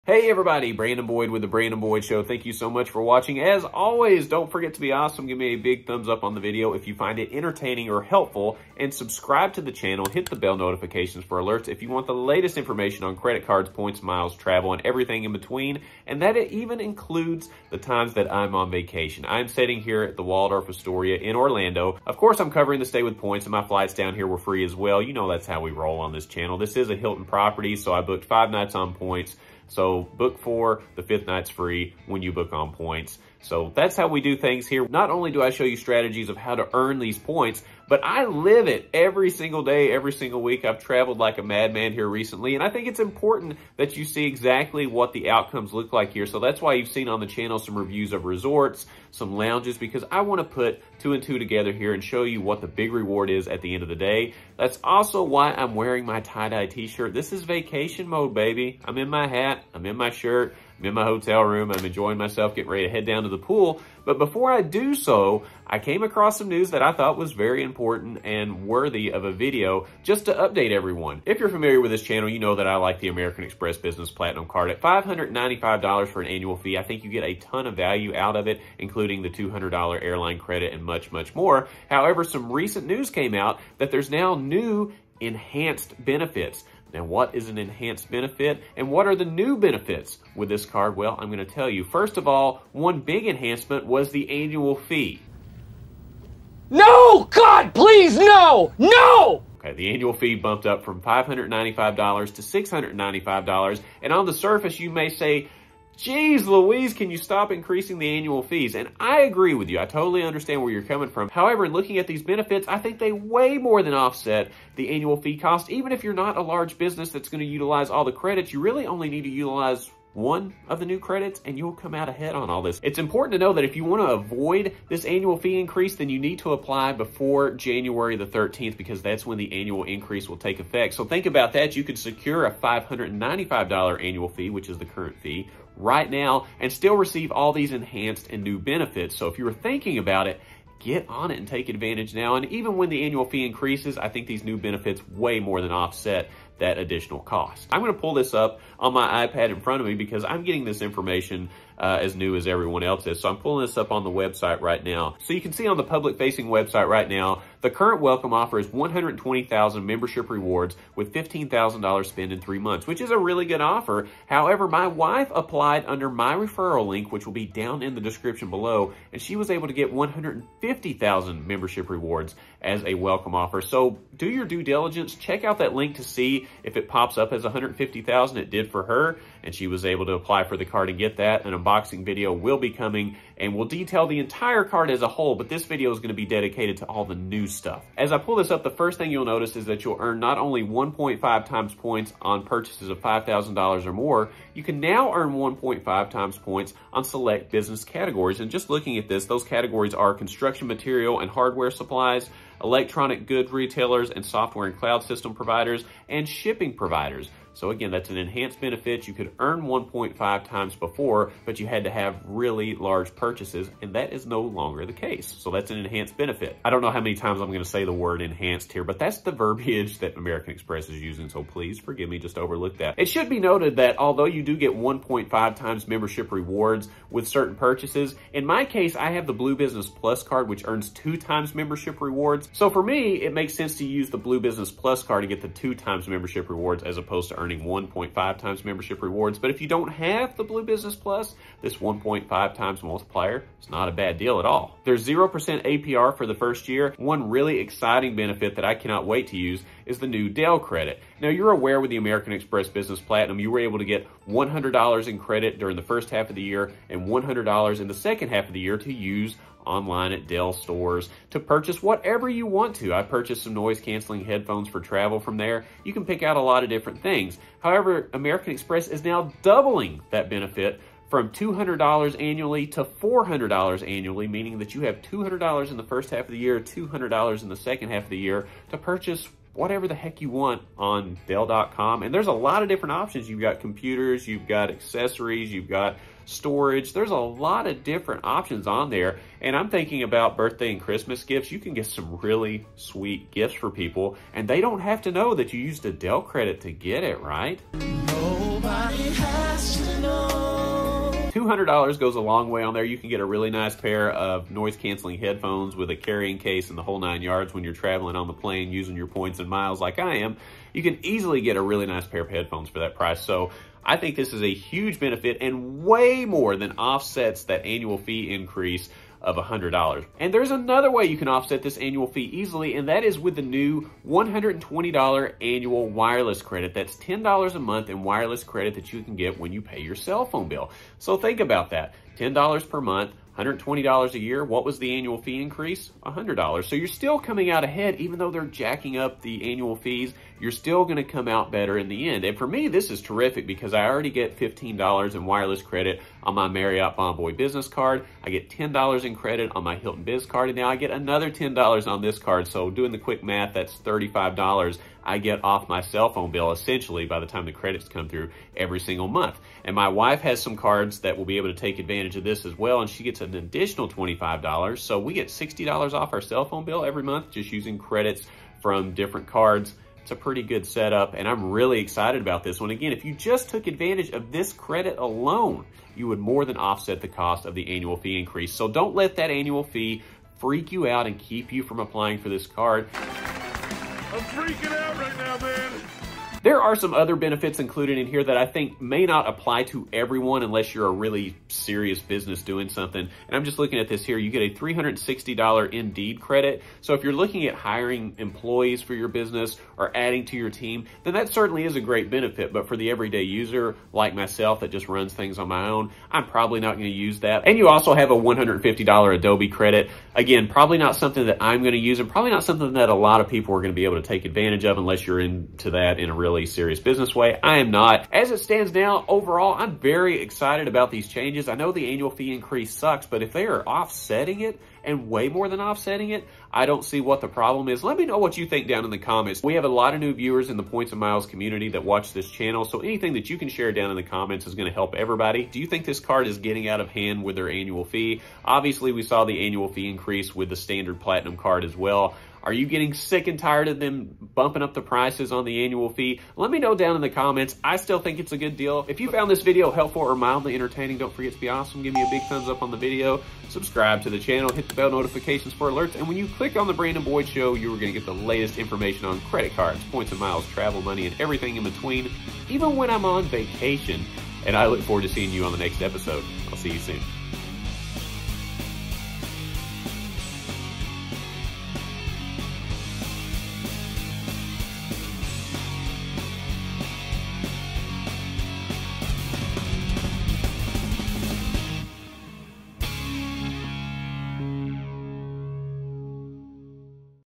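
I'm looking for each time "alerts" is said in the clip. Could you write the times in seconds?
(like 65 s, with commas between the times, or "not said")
11 s, 455 s.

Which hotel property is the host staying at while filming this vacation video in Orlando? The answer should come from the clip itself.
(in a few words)
Waldorf Astoria.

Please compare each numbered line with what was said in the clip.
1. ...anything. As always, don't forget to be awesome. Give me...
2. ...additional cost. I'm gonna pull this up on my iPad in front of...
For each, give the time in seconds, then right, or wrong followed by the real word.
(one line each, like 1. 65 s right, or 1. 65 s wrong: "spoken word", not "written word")
1. 3 s wrong: "watching", not "anything"
2. 146 s right.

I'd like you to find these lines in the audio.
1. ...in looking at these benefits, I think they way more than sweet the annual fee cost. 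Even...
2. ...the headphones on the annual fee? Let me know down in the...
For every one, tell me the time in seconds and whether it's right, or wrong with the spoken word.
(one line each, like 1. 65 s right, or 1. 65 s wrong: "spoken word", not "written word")
1. 111 s wrong: "offset", not "sweet"
2. 444 s wrong: "prices", not "headphones".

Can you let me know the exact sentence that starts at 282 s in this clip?
And there's a lot of different options.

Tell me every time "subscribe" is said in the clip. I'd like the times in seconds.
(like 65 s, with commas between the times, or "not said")
8 s, 453 s.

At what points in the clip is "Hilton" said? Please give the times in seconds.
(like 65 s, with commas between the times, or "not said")
26 s, 349 s.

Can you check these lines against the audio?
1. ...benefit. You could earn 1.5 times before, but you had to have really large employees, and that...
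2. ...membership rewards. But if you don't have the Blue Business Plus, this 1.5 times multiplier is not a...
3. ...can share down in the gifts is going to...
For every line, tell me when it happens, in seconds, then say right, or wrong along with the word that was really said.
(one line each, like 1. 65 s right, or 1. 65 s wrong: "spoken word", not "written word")
1. 208 s wrong: "purchases", not "employees"
2. 238 s right
3. 433 s wrong: "comments", not "gifts".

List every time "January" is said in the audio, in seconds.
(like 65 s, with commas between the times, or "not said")
127 s.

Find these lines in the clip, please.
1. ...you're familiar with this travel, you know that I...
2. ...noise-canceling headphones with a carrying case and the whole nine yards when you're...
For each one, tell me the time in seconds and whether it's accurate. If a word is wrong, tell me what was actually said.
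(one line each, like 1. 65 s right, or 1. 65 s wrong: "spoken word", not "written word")
1. 71 s wrong: "channel", not "travel"
2. 304 s right.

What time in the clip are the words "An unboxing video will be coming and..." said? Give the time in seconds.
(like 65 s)
181 s.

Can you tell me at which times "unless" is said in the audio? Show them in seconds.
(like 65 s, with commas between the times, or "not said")
390 s, 414 s.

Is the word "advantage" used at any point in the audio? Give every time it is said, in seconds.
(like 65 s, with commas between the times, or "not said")
141 s, 361 s, 373 s, 414 s.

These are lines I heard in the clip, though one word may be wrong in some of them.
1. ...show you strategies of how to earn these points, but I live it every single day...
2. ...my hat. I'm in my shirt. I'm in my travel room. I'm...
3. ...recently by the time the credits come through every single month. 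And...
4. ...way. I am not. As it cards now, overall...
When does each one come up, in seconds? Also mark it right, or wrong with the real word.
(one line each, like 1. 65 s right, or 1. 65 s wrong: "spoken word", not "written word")
1. 35 s right
2. 59 s wrong: "hotel", not "travel"
3. 356 s wrong: "essentially", not "recently"
4. 417 s wrong: "stands", not "cards".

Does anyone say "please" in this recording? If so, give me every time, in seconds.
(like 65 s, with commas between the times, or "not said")
97 s, 221 s.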